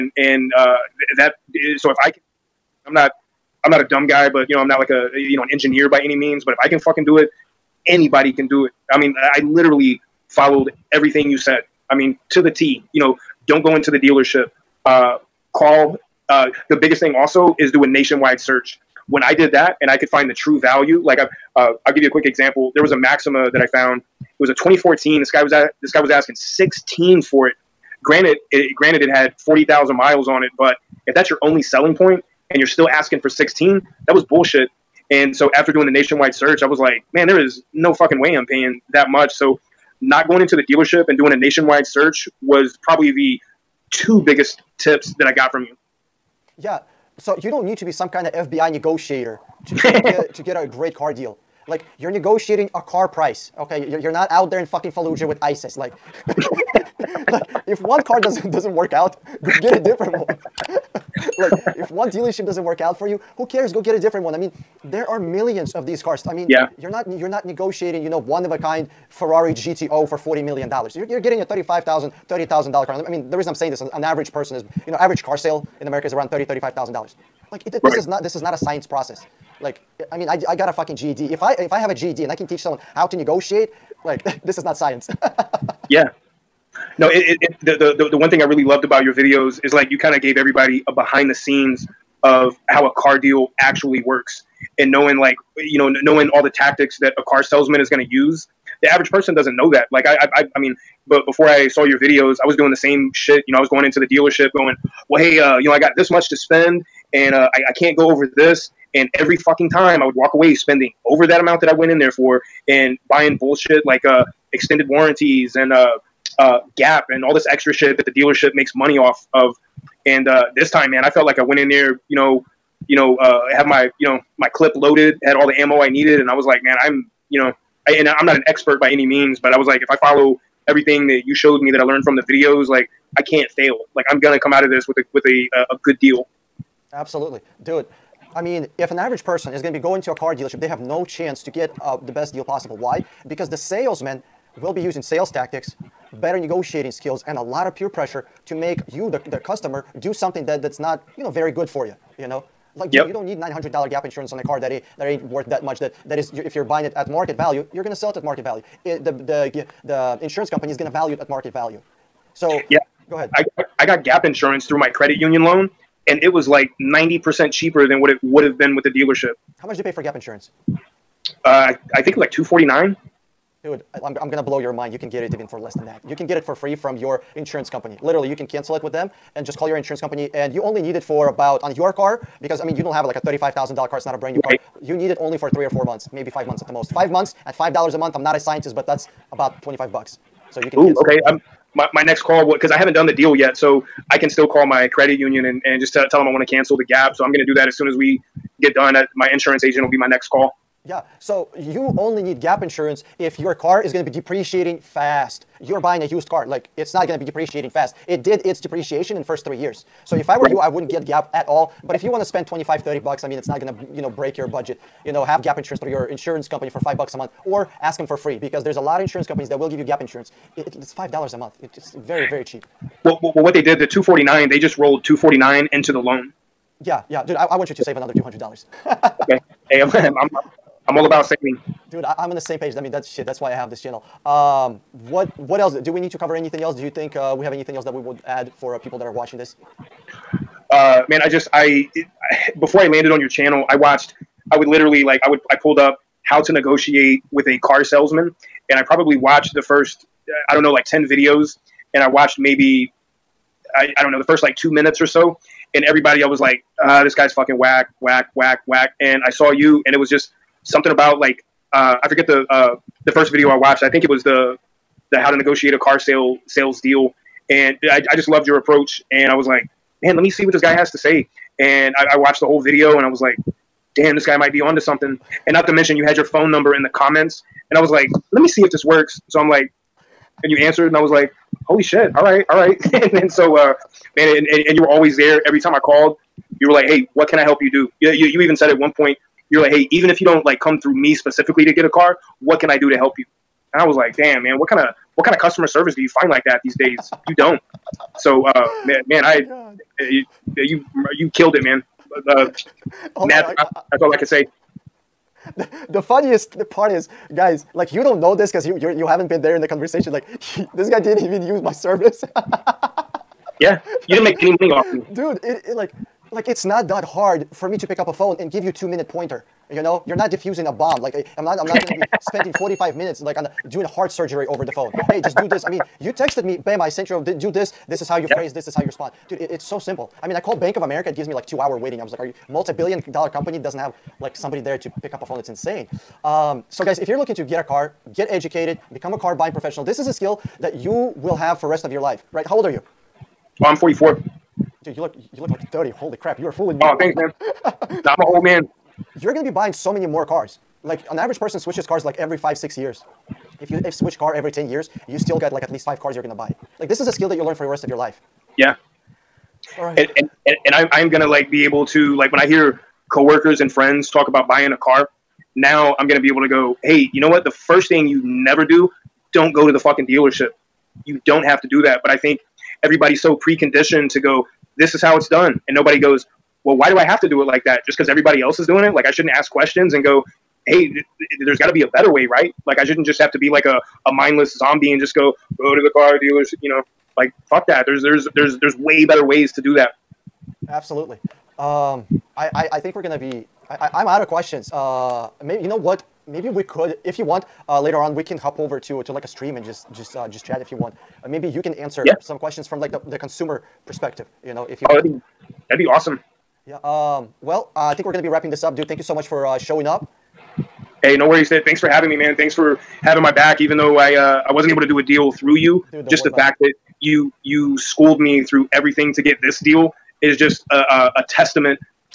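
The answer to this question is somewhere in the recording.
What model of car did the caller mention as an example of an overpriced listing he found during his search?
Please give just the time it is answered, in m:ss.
0:22.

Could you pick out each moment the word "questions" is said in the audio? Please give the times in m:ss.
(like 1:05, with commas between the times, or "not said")
6:19, 6:34, 6:42.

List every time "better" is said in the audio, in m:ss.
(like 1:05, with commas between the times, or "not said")
2:26, 6:21, 6:29.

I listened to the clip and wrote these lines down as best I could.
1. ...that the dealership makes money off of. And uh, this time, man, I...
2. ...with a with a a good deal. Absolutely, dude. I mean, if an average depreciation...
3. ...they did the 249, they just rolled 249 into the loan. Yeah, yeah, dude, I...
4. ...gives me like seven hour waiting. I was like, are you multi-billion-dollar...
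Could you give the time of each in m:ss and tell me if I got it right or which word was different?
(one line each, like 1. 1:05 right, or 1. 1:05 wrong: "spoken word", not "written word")
1. 1:57 right
2. 2:14 wrong: "person", not "depreciation"
3. 3:43 right
4. 5:31 wrong: "two", not "seven".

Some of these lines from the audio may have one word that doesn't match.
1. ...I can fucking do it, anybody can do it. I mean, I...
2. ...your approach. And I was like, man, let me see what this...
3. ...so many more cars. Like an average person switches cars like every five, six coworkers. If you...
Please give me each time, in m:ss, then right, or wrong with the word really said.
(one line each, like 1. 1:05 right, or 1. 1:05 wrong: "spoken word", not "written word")
1. 0:06 right
2. 4:28 right
3. 5:49 wrong: "years", not "coworkers".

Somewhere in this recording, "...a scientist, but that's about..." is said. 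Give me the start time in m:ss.
3:08.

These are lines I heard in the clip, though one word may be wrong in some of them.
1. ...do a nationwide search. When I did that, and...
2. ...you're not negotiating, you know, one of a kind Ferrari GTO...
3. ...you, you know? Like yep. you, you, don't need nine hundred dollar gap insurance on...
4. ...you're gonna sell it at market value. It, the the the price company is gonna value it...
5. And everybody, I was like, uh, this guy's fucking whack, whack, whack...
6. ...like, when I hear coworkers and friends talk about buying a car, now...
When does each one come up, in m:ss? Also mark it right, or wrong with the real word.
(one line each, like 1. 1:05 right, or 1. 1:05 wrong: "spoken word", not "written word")
1. 0:17 right
2. 1:07 right
3. 2:31 right
4. 2:37 wrong: "insurance", not "price"
5. 4:15 right
6. 6:02 right.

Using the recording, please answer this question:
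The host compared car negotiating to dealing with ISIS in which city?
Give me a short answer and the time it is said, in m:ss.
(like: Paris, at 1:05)
Fallujah, at 0:54.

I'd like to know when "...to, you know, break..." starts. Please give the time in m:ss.
3:33.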